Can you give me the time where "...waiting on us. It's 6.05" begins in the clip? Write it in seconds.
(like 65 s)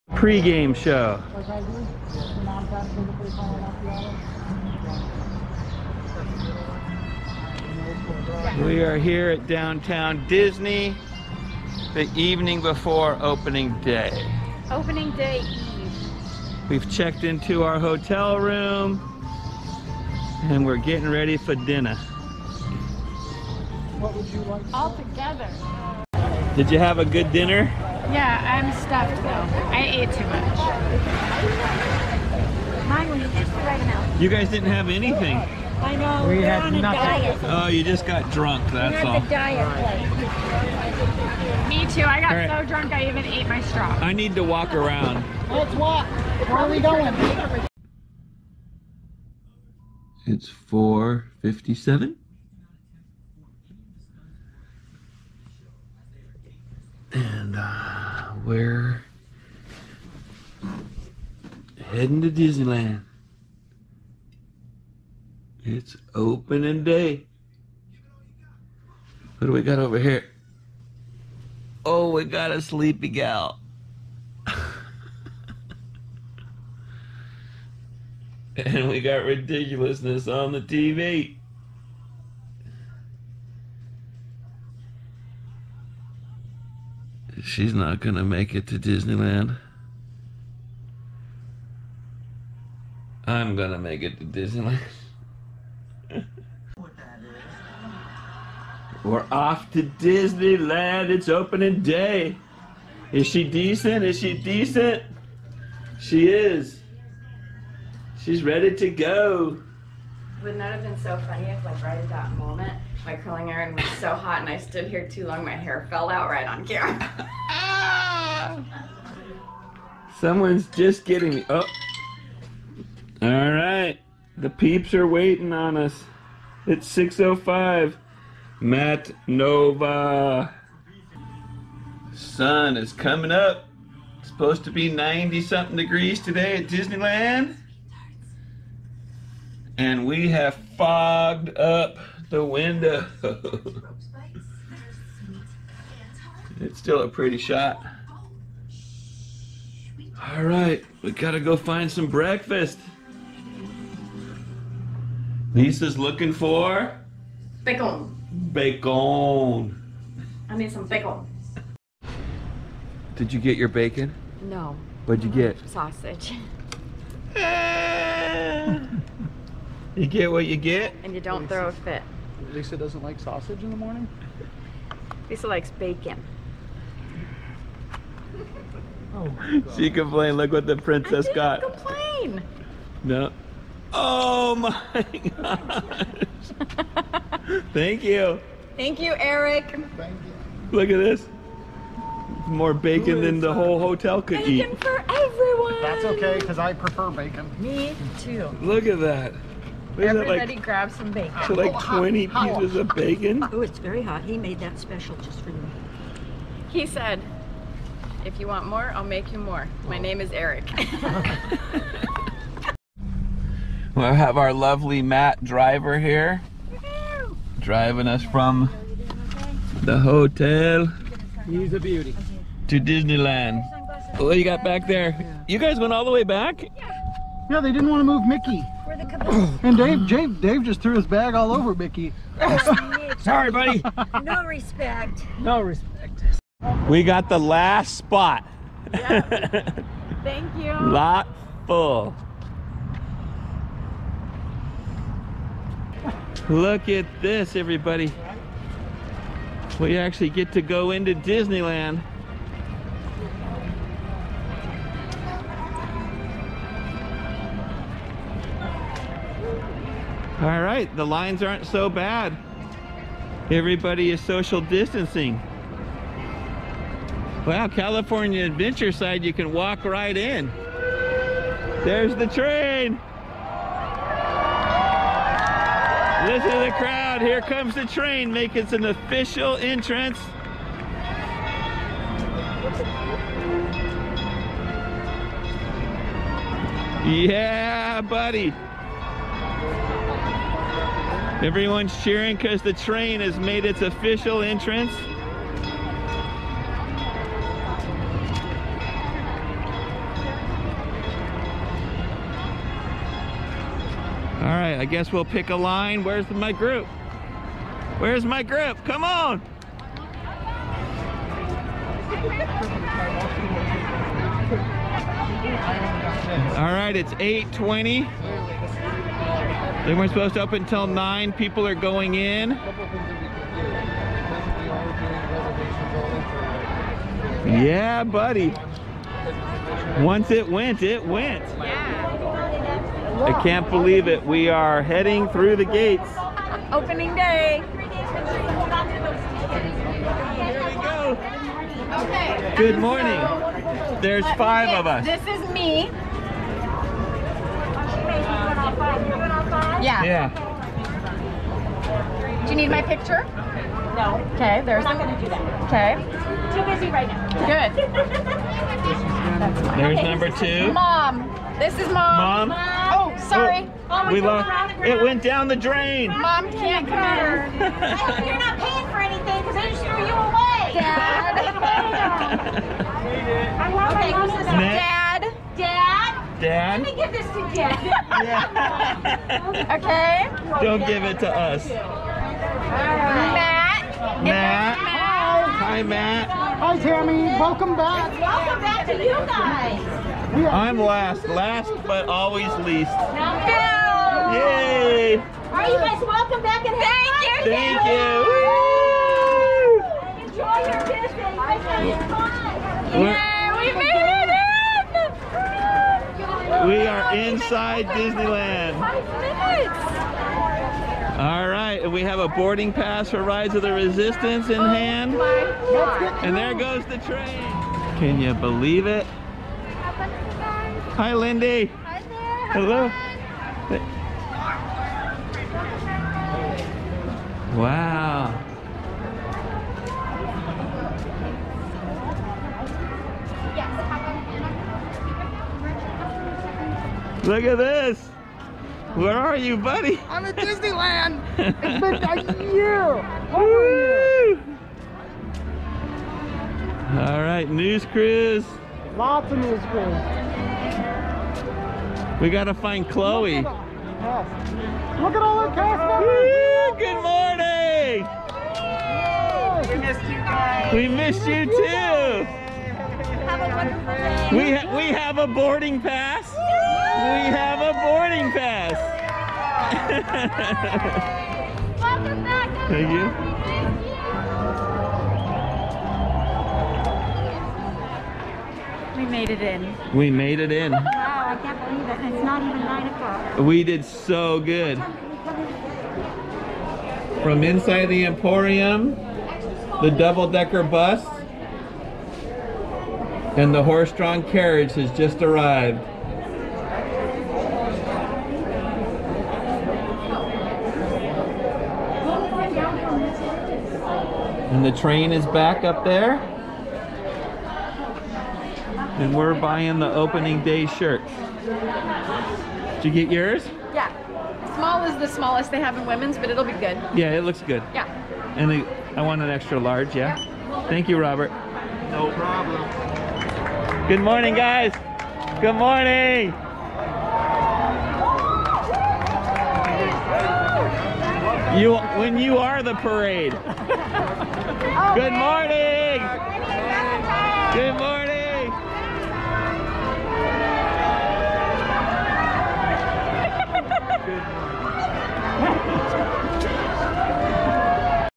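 125 s.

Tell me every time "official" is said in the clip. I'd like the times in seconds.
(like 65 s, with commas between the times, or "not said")
278 s, 293 s.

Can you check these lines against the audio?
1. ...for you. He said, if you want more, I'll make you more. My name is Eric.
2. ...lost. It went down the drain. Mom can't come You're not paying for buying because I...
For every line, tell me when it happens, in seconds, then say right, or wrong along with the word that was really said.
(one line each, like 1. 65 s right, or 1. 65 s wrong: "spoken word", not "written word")
1. 205 s right
2. 364 s wrong: "anything", not "buying".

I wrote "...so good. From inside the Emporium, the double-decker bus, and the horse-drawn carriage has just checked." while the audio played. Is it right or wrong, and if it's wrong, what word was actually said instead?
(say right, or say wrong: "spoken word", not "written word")
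wrong: "arrived", not "checked".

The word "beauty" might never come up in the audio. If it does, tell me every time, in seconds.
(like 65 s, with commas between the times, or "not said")
221 s.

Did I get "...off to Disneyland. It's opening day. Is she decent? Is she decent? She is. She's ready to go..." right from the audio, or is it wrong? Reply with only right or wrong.
right.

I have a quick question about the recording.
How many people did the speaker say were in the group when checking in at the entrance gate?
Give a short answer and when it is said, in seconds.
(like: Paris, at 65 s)
5, at 344 s.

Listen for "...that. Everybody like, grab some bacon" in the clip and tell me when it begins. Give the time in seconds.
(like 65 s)
199 s.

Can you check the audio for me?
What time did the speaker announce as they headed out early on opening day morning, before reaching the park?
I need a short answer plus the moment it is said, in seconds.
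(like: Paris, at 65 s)
4:57, at 50 s.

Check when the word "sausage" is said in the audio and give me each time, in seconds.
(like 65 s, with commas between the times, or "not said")
165 s, 173 s.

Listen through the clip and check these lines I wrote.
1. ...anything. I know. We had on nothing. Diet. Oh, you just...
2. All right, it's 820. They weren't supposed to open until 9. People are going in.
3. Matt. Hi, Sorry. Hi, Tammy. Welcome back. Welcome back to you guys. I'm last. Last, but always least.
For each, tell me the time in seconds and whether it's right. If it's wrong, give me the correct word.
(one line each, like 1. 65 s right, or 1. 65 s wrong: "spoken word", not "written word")
1. 34 s right
2. 316 s right
3. 384 s wrong: "Matt", not "Sorry".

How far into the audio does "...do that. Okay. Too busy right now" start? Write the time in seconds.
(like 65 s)
355 s.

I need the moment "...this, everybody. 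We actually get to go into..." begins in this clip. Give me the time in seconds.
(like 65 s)
247 s.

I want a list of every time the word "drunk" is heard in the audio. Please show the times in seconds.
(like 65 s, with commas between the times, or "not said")
38 s, 42 s.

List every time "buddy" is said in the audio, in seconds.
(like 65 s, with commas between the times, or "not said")
233 s, 288 s, 328 s, 439 s.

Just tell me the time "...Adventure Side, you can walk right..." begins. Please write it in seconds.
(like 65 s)
268 s.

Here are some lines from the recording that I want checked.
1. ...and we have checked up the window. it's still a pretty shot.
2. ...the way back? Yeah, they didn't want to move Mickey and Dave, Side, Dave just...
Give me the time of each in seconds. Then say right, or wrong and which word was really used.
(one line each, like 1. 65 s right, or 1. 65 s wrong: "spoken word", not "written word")
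1. 139 s wrong: "fogged", not "checked"
2. 226 s wrong: "Dave", not "Side".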